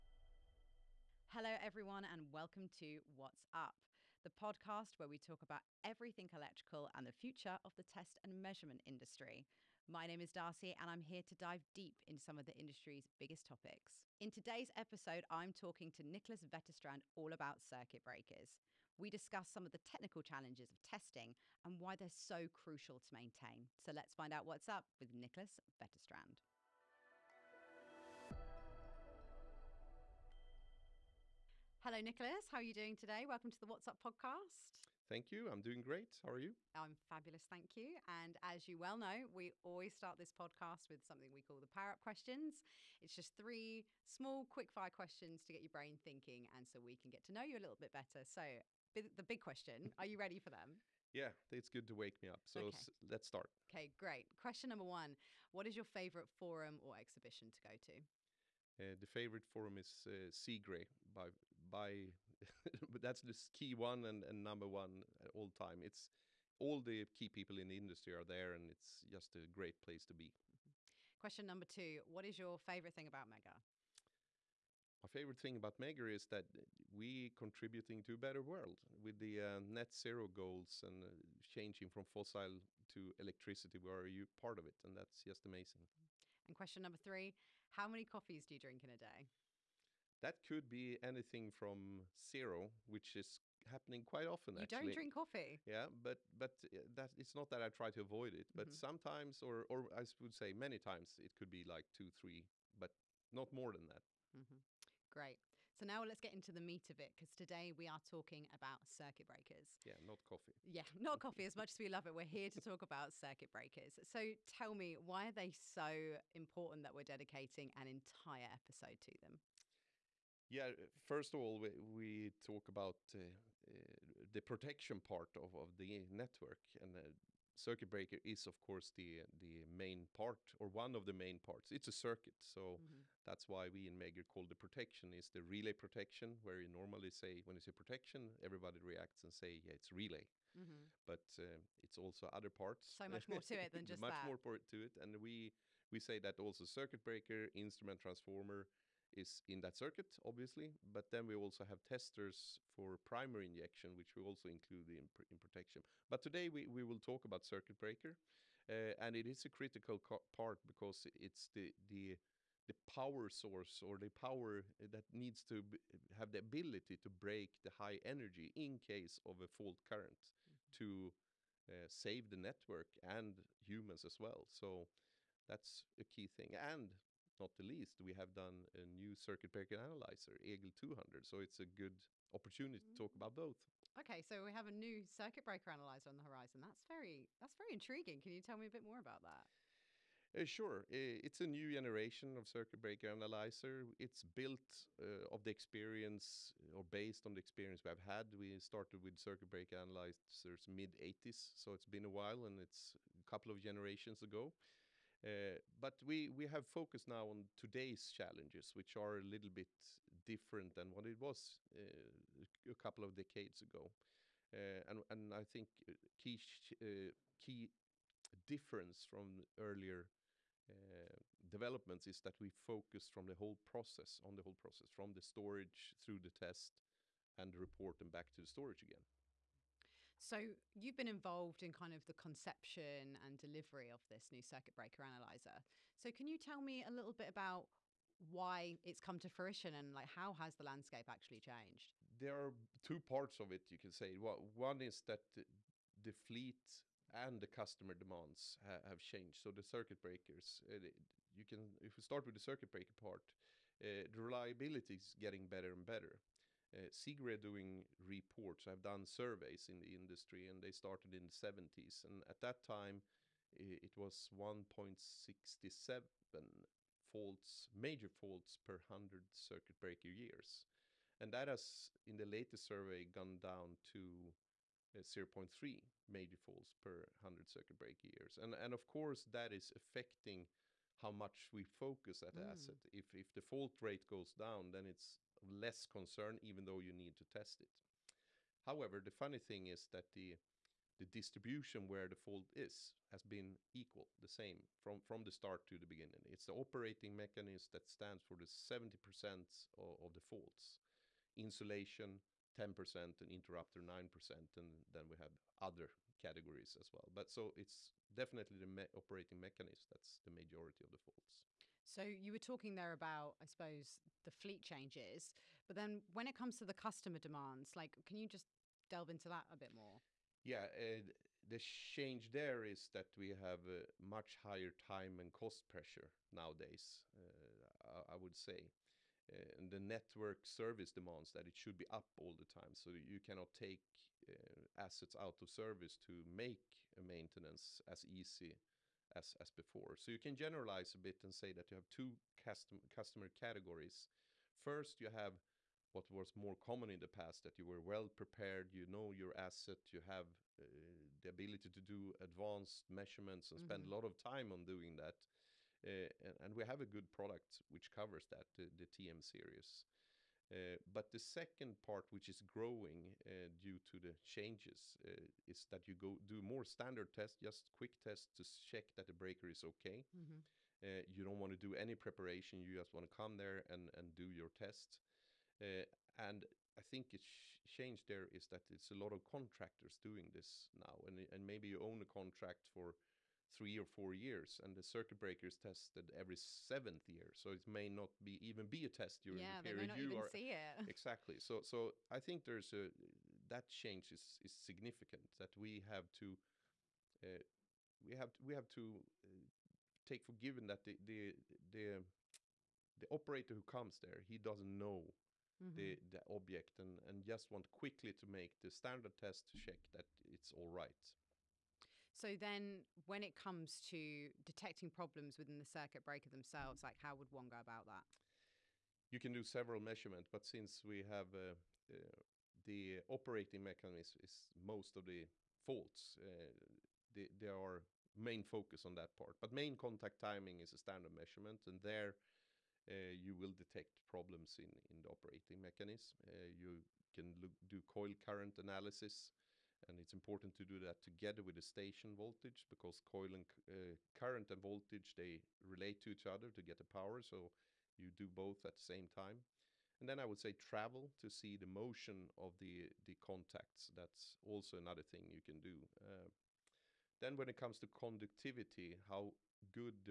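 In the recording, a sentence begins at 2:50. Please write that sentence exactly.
to uh, save the network and humans as well.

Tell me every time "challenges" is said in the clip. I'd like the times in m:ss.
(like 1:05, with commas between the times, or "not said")
0:20, 3:28.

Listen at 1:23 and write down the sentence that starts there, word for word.
We are you part of it, and that's just amazing.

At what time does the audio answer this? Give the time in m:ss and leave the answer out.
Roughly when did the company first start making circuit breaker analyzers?
3:20.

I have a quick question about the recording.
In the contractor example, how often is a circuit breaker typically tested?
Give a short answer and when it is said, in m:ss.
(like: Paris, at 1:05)
every 7th year, at 6:26.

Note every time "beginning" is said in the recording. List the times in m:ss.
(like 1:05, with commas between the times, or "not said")
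4:55.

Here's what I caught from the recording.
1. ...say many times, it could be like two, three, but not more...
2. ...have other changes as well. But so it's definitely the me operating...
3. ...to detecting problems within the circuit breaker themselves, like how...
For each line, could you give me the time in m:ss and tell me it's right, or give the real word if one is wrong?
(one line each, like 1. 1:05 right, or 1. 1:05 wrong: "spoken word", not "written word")
1. 1:40 right
2. 5:05 wrong: "categories", not "changes"
3. 6:53 right.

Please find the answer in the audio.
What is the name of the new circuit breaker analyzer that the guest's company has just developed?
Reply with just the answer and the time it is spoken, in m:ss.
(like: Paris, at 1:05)
EGIL 200, at 3:00.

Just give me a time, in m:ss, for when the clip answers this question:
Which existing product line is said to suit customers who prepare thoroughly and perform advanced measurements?
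5:58.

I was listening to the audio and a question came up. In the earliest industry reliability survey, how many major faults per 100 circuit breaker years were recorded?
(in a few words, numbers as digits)
1.67.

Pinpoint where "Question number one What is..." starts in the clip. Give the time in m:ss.
0:54.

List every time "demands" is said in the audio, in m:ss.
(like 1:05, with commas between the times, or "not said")
4:07, 5:17, 5:30.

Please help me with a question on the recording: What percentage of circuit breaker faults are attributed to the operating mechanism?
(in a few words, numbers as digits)
70%.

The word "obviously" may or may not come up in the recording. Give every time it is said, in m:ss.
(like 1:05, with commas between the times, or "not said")
2:30.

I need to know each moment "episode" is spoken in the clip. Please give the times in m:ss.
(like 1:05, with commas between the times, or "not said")
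0:14, 1:58.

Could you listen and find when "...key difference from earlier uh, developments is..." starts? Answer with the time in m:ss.
3:37.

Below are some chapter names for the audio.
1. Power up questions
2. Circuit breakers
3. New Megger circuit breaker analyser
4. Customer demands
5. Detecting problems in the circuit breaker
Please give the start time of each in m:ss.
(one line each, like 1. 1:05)
1. 0:53
2. 1:44
3. 3:03
4. 5:10
5. 6:51.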